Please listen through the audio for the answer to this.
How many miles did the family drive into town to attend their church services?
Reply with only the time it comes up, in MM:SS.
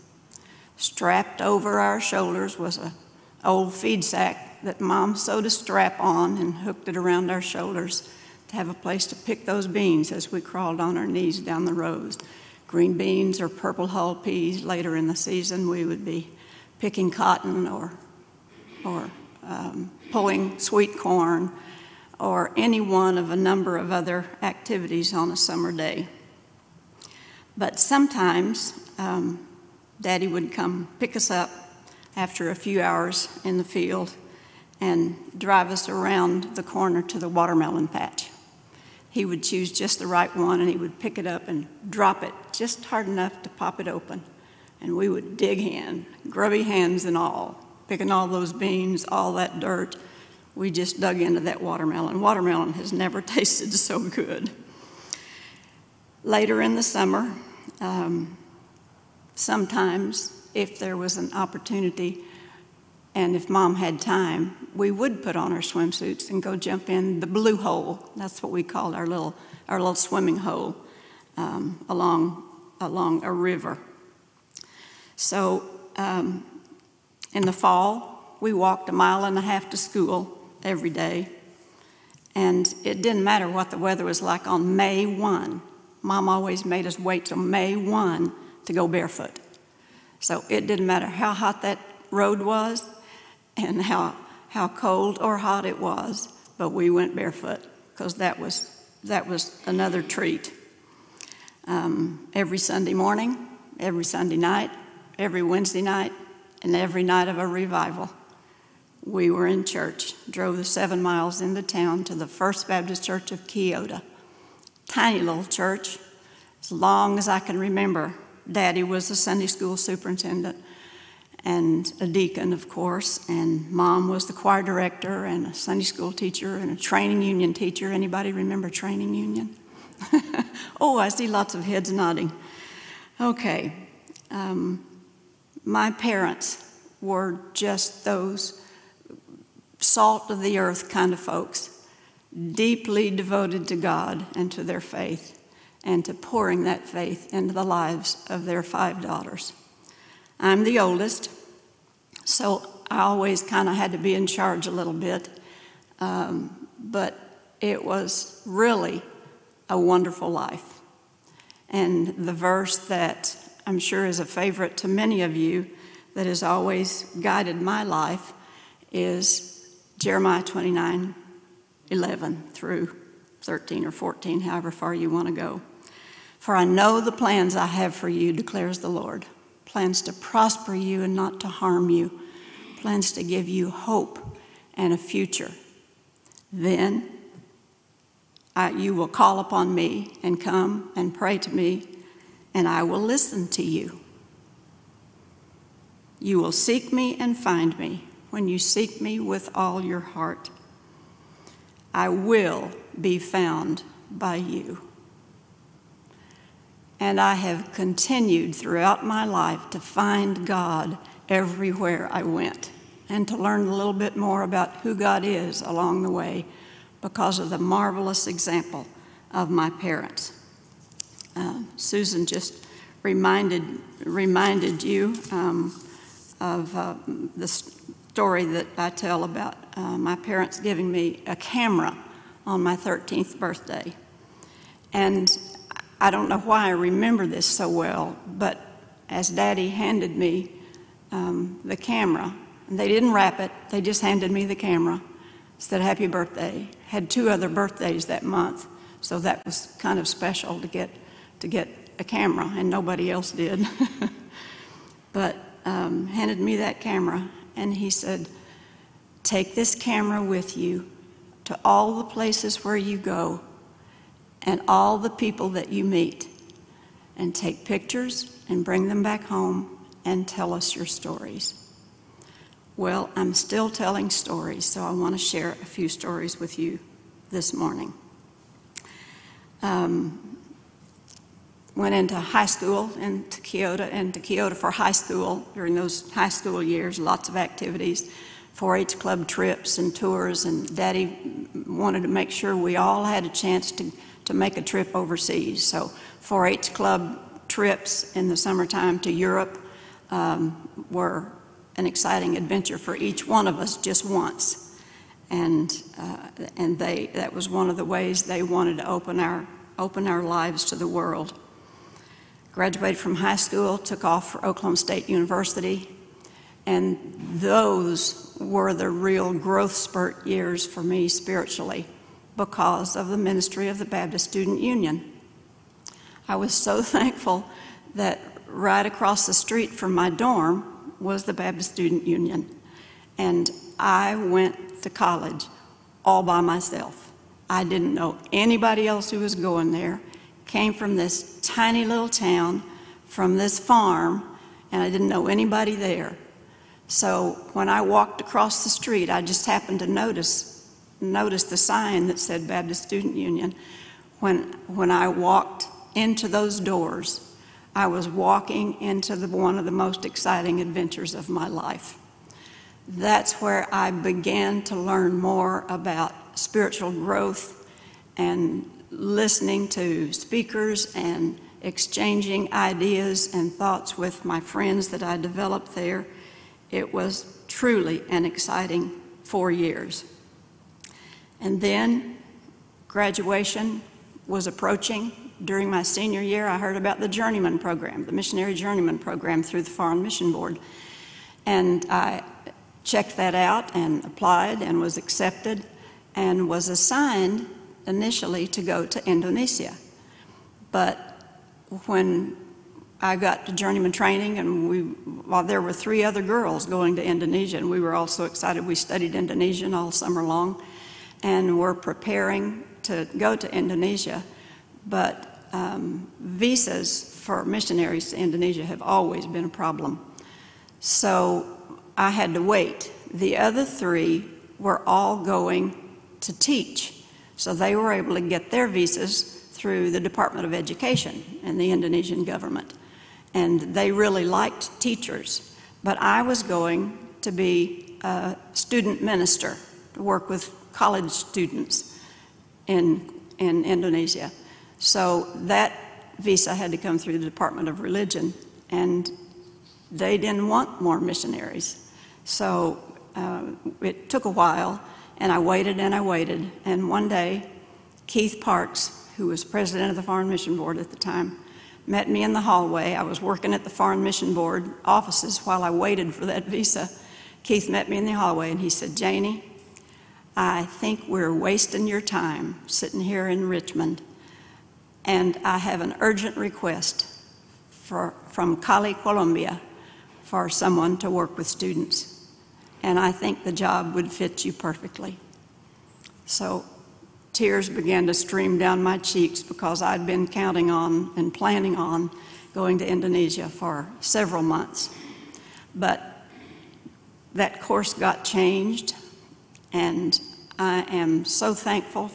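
01:50.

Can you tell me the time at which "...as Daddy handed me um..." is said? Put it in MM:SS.
03:59.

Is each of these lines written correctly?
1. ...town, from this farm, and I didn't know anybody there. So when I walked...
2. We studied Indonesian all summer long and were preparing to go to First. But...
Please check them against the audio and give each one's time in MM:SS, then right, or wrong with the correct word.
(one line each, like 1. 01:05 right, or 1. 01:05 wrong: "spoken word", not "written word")
1. 05:42 right
2. 06:48 wrong: "Indonesia", not "First".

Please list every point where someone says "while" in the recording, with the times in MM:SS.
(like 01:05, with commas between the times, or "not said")
06:44, 07:34, 07:45.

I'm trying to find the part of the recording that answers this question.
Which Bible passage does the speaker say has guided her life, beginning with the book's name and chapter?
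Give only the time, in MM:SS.
02:49.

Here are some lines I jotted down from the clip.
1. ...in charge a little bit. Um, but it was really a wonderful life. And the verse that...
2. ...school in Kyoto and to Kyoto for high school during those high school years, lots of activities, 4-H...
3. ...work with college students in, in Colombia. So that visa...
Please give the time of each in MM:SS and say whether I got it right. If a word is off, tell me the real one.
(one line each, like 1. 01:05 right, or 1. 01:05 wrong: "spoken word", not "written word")
1. 02:34 right
2. 04:42 right
3. 07:20 wrong: "Indonesia", not "Colombia".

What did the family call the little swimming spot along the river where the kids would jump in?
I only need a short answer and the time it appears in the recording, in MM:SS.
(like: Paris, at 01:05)
the blue hole, at 01:07.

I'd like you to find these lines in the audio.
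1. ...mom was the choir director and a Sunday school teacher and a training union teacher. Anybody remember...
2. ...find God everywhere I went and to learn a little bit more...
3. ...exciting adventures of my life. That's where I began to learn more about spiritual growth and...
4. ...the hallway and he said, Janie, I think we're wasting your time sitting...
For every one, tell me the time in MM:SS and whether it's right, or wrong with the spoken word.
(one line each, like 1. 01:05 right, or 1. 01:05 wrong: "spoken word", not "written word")
1. 02:03 right
2. 03:29 right
3. 06:00 right
4. 07:48 right.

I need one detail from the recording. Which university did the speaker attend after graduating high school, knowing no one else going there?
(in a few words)
Oklahoma State University.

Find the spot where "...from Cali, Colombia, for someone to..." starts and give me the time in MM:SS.
07:58.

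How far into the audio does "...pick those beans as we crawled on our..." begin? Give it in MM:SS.
00:09.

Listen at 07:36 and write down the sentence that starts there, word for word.
And one day, Keith Parks, who was president of the Foreign Mission Board at the time, met me in the hallway.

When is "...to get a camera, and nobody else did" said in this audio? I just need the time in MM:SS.
04:11.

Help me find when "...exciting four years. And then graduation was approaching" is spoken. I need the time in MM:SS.
06:18.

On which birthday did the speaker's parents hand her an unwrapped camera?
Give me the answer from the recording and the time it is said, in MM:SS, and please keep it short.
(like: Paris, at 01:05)
13th, at 03:52.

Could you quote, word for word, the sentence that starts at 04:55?
So 4-H club trips in the summertime to Europe um, were an exciting adventure for each one of us just once.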